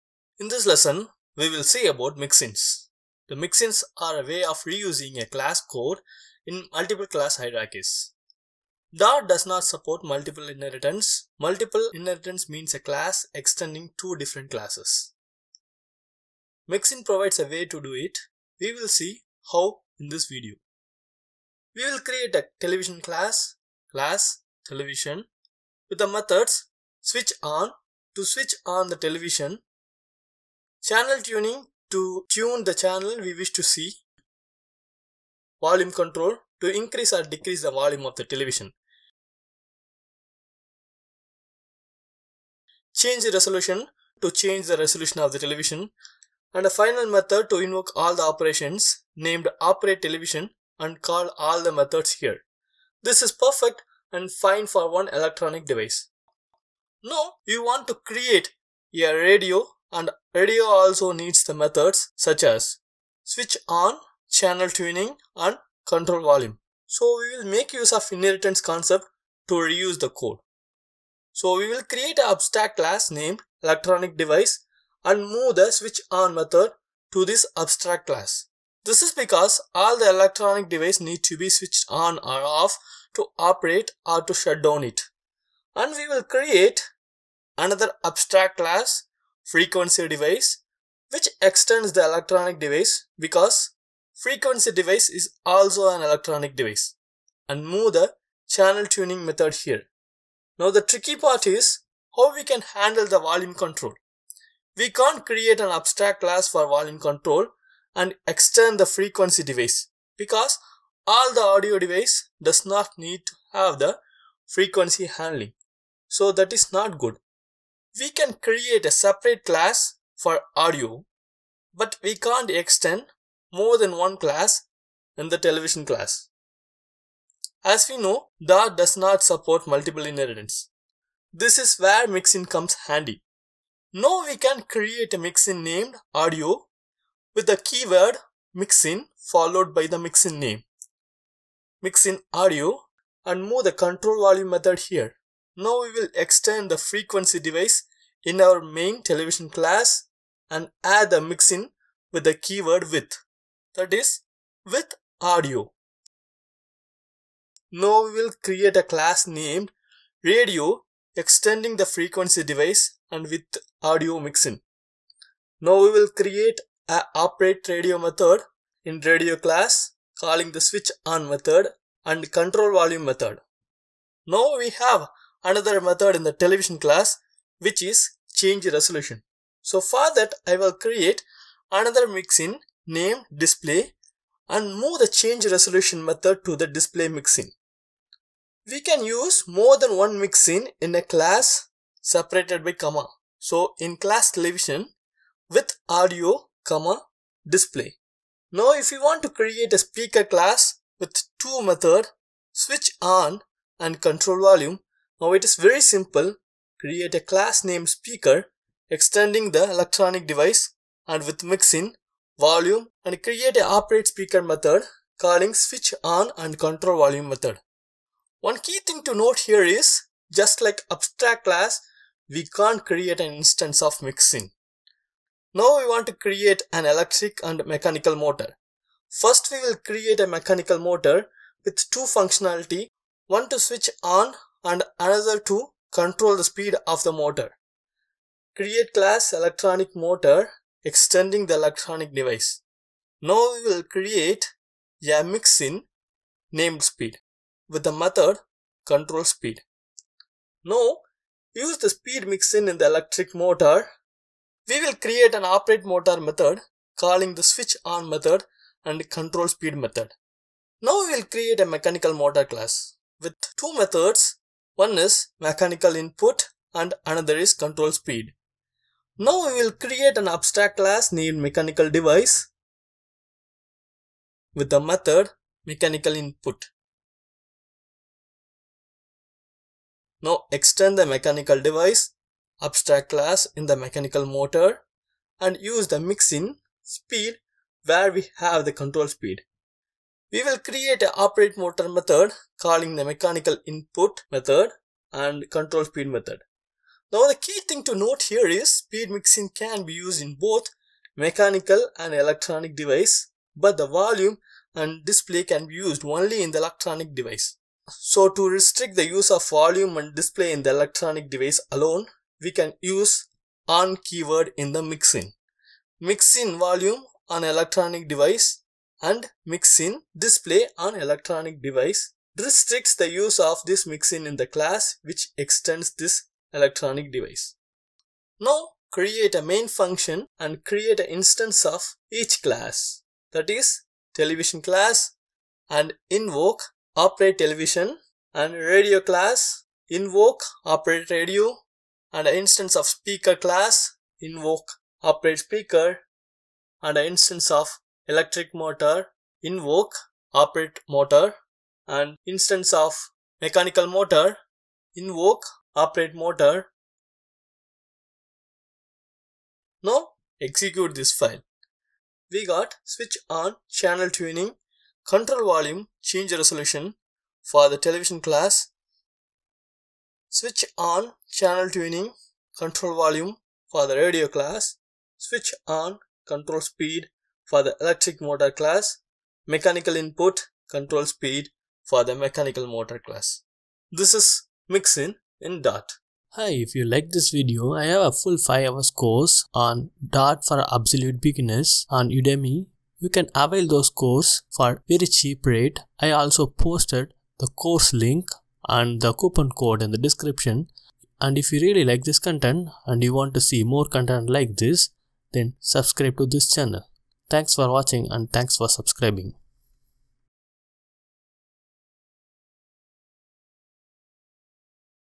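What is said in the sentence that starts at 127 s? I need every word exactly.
As we know, Dart does not support multiple inheritance.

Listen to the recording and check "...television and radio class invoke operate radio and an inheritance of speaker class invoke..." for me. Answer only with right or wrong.
wrong.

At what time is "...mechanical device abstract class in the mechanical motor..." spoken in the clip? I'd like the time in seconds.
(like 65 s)
281 s.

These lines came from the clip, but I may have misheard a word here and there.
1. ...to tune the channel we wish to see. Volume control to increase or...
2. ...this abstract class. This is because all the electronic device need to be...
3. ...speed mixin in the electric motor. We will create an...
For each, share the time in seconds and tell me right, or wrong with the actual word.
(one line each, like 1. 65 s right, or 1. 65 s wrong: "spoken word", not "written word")
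1. 31 s right
2. 77 s right
3. 251 s right.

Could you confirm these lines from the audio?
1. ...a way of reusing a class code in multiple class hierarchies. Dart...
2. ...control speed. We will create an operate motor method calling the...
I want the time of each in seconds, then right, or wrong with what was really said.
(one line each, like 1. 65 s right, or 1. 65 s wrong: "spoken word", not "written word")
1. 4 s right
2. 288 s right.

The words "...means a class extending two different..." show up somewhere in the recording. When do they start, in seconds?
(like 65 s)
12 s.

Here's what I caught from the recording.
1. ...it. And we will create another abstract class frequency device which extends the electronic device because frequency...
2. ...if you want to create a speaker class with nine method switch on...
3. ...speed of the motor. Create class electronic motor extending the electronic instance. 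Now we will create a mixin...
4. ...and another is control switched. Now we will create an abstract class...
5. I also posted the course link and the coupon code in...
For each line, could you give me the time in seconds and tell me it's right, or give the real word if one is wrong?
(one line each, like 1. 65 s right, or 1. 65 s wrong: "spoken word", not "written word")
1. 84 s right
2. 198 s wrong: "two", not "nine"
3. 236 s wrong: "device", not "instance"
4. 266 s wrong: "speed", not "switched"
5. 395 s right.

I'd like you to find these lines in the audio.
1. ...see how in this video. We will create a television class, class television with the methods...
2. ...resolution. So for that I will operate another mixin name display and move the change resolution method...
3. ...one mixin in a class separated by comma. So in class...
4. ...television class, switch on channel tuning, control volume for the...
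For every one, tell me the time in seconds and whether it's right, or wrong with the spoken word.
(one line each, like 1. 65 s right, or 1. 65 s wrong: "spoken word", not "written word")
1. 18 s right
2. 178 s wrong: "create", not "operate"
3. 189 s right
4. 367 s right.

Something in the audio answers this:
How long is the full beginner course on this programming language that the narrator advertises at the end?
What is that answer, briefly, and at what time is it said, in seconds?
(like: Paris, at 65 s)
5 hours, at 388 s.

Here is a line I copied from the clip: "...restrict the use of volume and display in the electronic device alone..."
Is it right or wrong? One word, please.
right.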